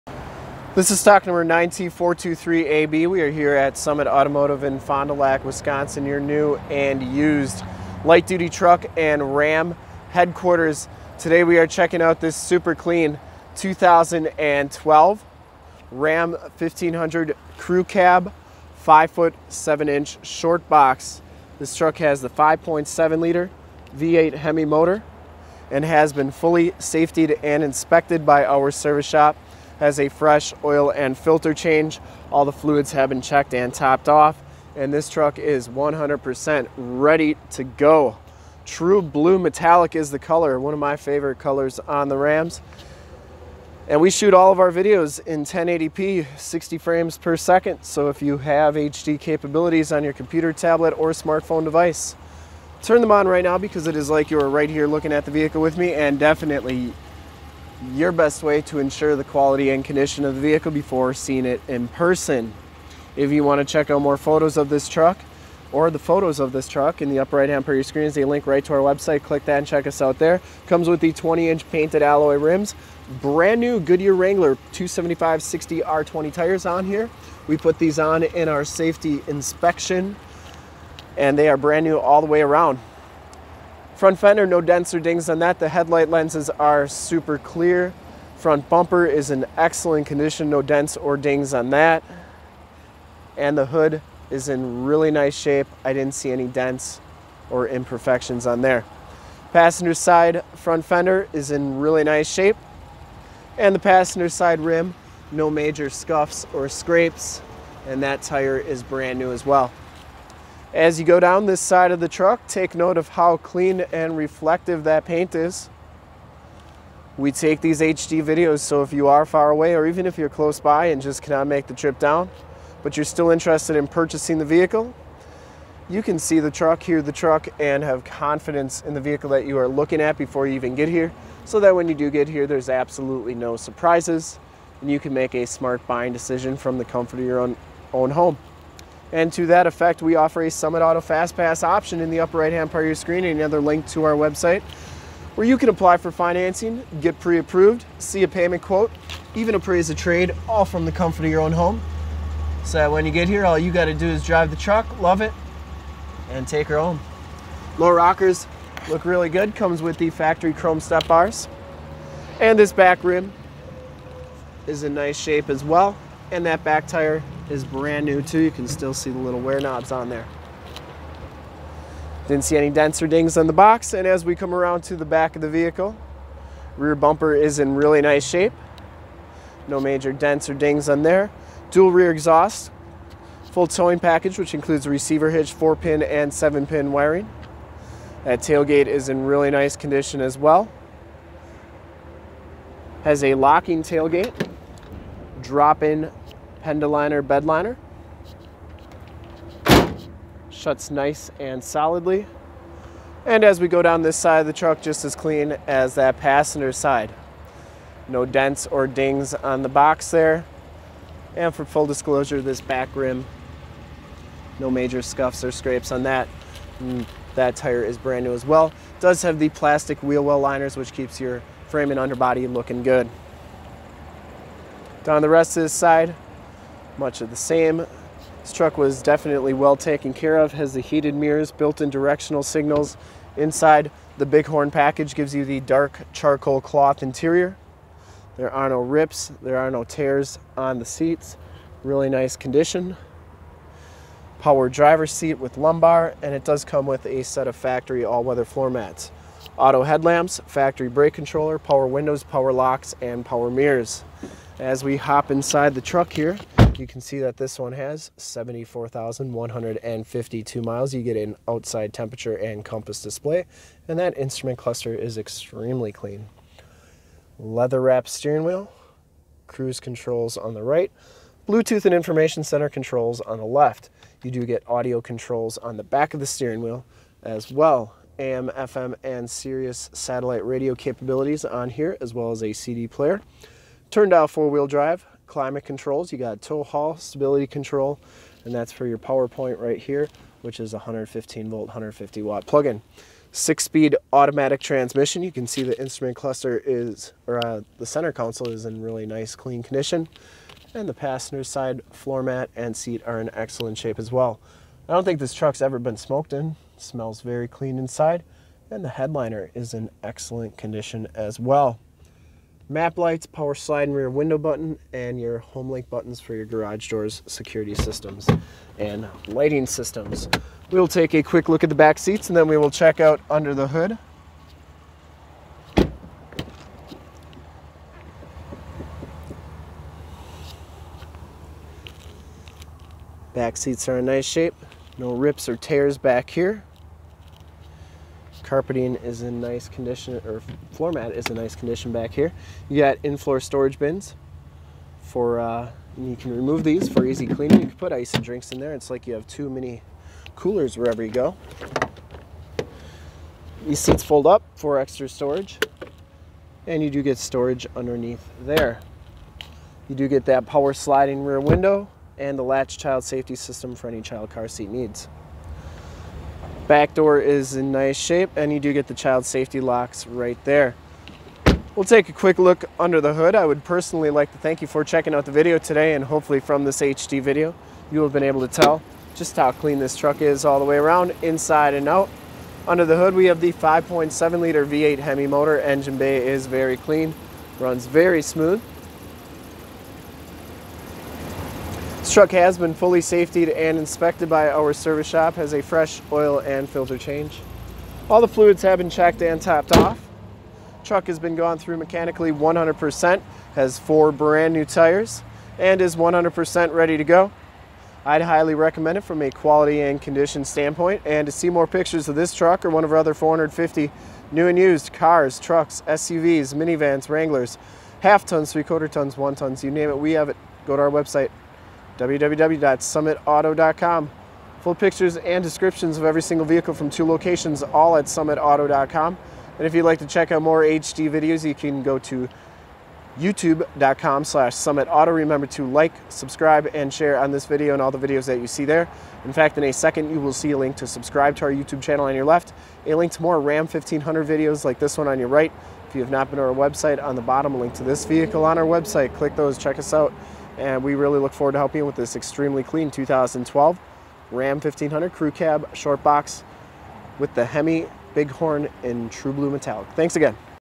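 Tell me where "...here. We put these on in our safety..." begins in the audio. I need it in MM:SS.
01:16.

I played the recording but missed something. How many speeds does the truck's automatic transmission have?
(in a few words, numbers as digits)
6.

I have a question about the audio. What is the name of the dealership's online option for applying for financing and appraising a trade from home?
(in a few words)
Summit Auto Fast Pass.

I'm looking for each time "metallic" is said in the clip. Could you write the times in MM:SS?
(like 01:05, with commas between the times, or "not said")
00:39, 07:39.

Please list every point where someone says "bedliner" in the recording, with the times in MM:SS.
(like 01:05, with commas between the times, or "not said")
03:16.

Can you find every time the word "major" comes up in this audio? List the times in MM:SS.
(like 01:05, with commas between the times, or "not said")
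01:45, 02:59, 03:34.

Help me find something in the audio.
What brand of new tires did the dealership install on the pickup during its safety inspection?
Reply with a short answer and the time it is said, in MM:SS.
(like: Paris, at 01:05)
Goodyear Wrangler, at 01:13.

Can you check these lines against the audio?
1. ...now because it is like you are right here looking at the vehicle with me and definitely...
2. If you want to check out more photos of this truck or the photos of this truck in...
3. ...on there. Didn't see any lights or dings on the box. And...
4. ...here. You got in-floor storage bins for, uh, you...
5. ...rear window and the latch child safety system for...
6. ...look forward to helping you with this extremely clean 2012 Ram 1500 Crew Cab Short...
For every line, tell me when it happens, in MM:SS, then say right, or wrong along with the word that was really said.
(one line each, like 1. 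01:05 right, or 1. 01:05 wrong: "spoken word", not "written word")
1. 00:53 right
2. 01:03 right
3. 02:49 wrong: "dents", not "lights"
4. 05:42 right
5. 06:01 right
6. 07:31 right.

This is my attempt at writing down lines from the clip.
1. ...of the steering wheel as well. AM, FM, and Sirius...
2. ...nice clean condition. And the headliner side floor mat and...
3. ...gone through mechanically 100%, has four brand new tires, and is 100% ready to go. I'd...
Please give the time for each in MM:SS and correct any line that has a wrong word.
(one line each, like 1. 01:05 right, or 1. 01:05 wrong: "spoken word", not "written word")
1. 04:36 right
2. 04:59 wrong: "passenger", not "headliner"
3. 06:41 right.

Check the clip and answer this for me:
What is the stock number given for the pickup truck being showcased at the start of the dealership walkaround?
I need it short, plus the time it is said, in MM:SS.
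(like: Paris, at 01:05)
9T423AB, at 00:01.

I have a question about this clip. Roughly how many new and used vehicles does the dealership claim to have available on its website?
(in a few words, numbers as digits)
450.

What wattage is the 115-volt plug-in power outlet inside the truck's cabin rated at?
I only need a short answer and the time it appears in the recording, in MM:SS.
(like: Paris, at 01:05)
150 watt, at 04:51.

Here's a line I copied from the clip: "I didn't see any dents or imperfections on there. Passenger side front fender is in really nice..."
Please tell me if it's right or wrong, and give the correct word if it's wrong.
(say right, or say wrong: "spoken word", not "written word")
right.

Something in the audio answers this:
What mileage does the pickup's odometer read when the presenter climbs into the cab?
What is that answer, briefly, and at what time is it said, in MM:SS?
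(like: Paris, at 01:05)
74,152 miles, at 04:18.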